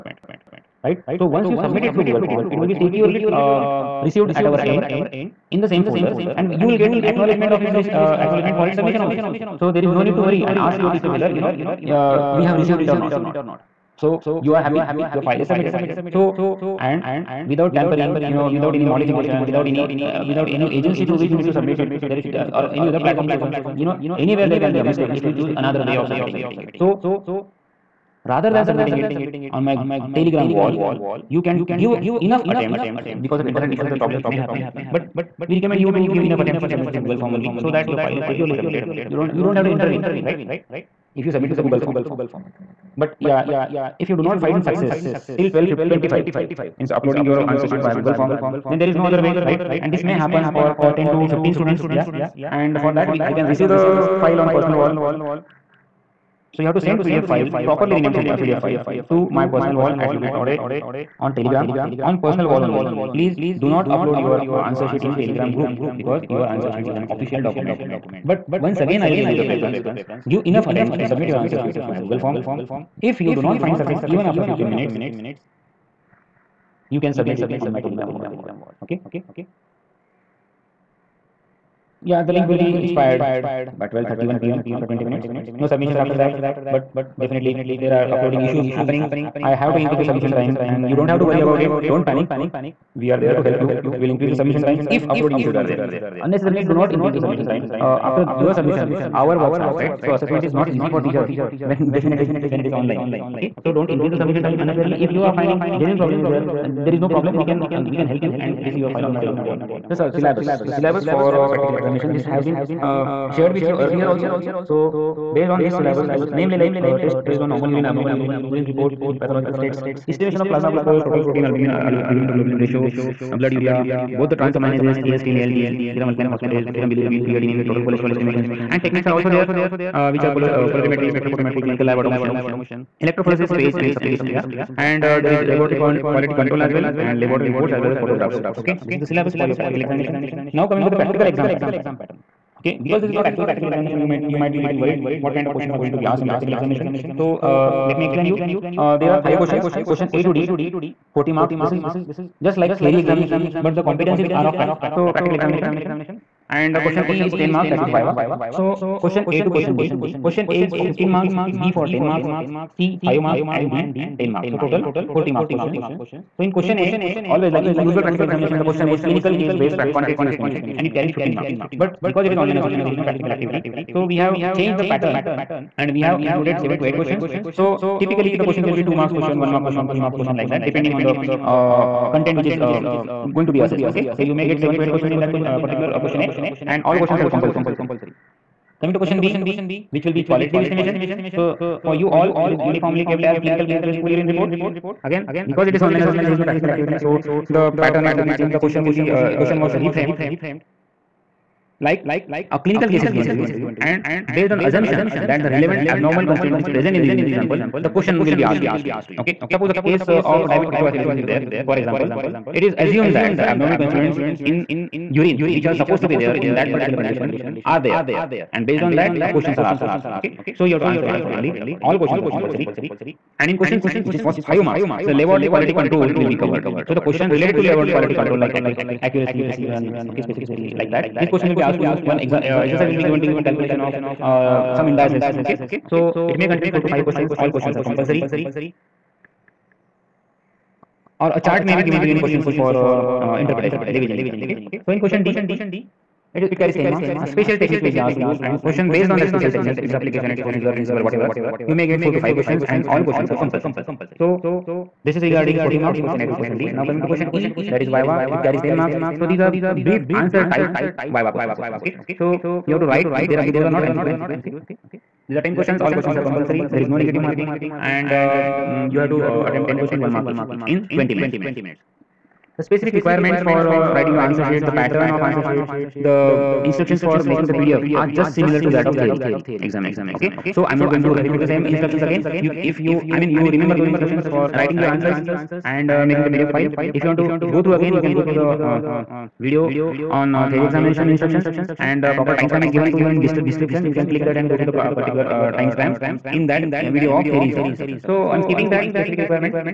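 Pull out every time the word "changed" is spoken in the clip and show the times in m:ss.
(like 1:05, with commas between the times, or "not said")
2:54, 3:18.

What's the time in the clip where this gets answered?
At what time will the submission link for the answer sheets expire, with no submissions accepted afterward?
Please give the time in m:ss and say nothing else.
1:23.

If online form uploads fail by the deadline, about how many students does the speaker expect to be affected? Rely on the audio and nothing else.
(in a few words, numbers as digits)
10 to 15.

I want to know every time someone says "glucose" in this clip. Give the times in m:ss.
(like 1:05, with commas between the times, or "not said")
2:00.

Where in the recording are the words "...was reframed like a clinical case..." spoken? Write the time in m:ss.
3:19.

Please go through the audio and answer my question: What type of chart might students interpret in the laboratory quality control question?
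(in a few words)
Levey chart.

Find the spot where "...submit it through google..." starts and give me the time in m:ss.
0:01.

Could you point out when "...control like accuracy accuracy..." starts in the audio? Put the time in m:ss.
3:48.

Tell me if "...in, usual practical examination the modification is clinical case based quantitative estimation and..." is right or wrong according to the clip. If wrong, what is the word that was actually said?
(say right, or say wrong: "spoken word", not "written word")
wrong: "question", not "modification".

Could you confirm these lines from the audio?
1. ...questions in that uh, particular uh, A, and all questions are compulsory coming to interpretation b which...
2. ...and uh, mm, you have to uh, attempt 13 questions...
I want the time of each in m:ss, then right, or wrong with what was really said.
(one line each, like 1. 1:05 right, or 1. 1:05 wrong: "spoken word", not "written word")
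1. 3:04 wrong: "question", not "interpretation"
2. 4:27 wrong: "10", not "13".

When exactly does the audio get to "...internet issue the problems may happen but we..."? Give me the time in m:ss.
0:33.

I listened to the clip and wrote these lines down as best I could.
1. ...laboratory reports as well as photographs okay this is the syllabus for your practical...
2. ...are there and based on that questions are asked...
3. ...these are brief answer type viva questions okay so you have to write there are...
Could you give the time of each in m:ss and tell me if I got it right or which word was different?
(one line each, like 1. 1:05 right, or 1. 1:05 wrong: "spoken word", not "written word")
1. 2:17 right
2. 3:37 right
3. 4:19 right.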